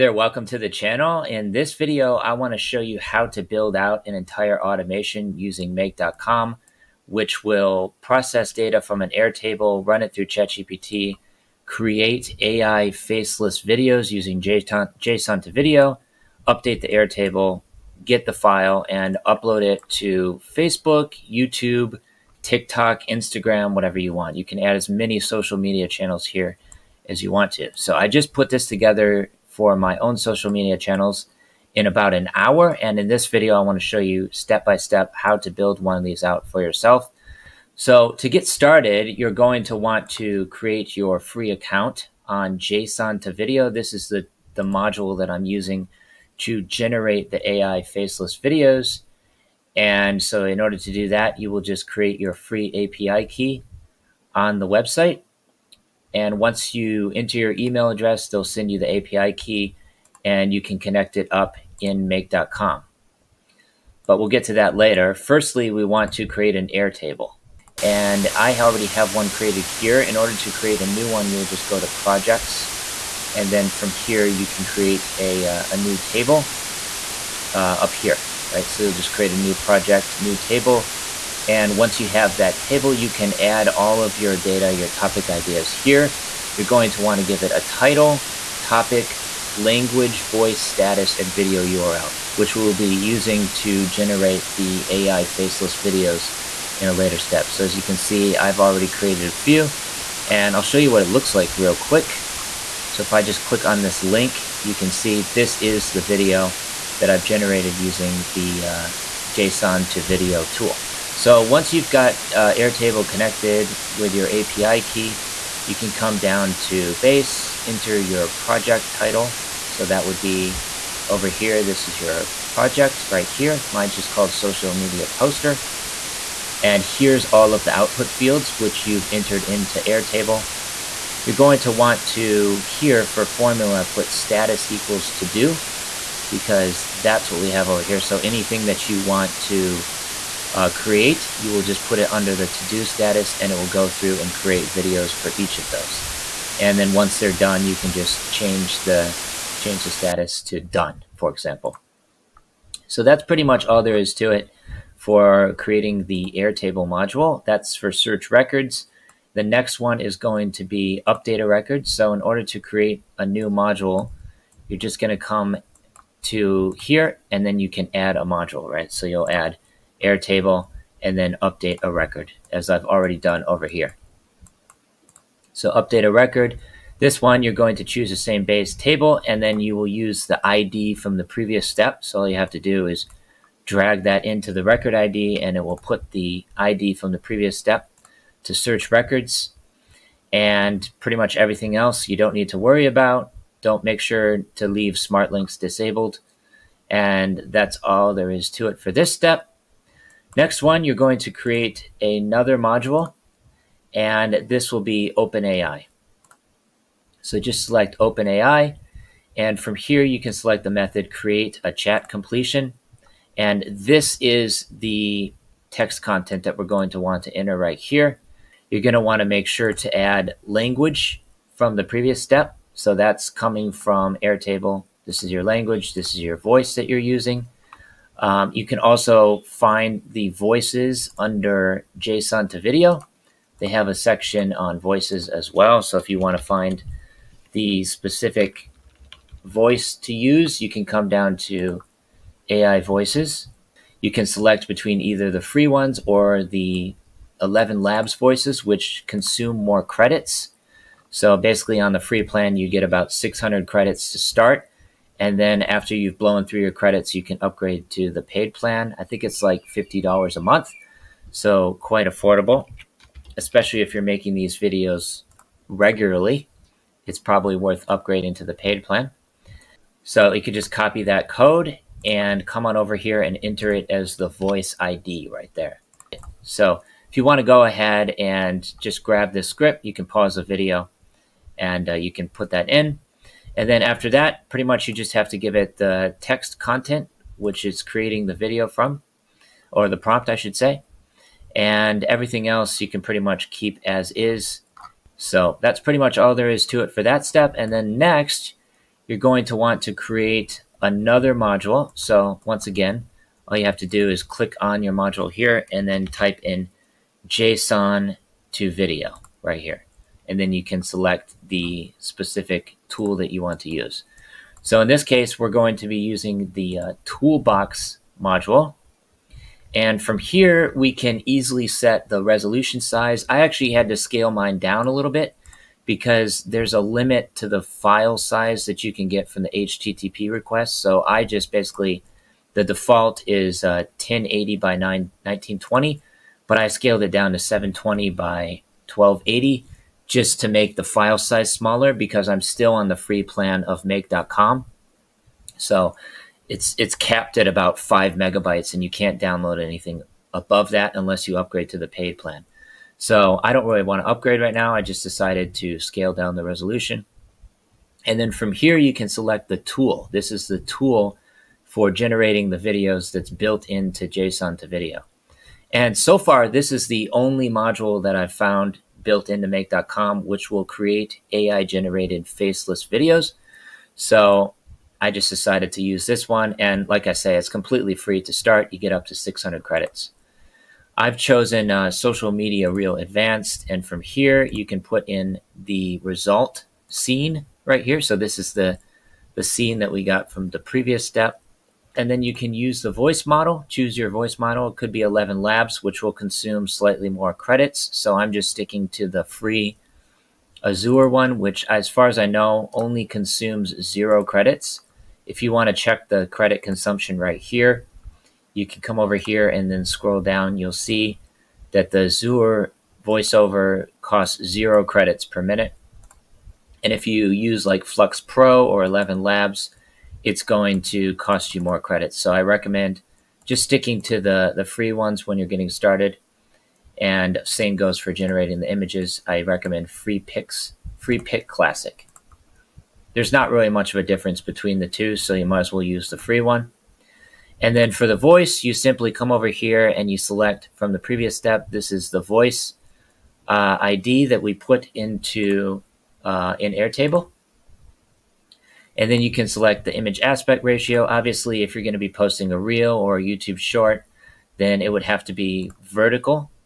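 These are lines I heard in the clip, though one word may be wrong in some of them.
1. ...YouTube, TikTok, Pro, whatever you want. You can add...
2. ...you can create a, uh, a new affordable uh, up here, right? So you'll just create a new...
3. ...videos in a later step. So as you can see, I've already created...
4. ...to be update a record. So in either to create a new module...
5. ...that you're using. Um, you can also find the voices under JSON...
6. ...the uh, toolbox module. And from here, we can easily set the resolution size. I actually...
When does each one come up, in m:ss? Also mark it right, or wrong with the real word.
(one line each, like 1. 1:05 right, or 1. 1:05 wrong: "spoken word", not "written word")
1. 0:21 wrong: "Instagram", not "Pro"
2. 1:14 wrong: "table", not "affordable"
3. 1:35 right
4. 2:40 wrong: "order", not "either"
5. 3:46 right
6. 5:16 right.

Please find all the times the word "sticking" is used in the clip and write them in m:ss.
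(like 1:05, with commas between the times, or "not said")
6:38, 7:03.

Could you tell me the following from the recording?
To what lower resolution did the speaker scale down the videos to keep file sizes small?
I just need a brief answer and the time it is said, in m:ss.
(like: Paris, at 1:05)
720 by 1280, at 5:37.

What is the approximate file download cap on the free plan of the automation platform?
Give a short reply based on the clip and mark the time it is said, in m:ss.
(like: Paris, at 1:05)
5 megabytes, at 5:47.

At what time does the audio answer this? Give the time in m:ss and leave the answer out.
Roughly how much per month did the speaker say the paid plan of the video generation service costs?
4:19.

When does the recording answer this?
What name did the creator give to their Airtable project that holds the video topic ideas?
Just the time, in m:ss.
2:04.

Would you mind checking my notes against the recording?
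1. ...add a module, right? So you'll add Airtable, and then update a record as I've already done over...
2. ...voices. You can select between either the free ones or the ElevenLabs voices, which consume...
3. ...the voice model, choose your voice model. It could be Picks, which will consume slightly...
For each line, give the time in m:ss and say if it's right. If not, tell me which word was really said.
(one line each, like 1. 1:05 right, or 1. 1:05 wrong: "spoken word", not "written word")
1. 2:47 right
2. 4:02 right
3. 6:32 wrong: "ElevenLabs", not "Picks".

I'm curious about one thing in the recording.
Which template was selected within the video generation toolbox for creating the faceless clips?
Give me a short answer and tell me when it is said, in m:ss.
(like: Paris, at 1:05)
social media reel advanced, at 6:21.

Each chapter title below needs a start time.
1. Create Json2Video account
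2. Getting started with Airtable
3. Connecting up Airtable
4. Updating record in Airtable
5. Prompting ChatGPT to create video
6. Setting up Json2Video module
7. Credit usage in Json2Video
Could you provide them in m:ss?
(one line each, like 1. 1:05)
1. 0:40
2. 1:07
3. 1:59
4. 2:47
5. 3:34
6. 4:57
7. 6:47.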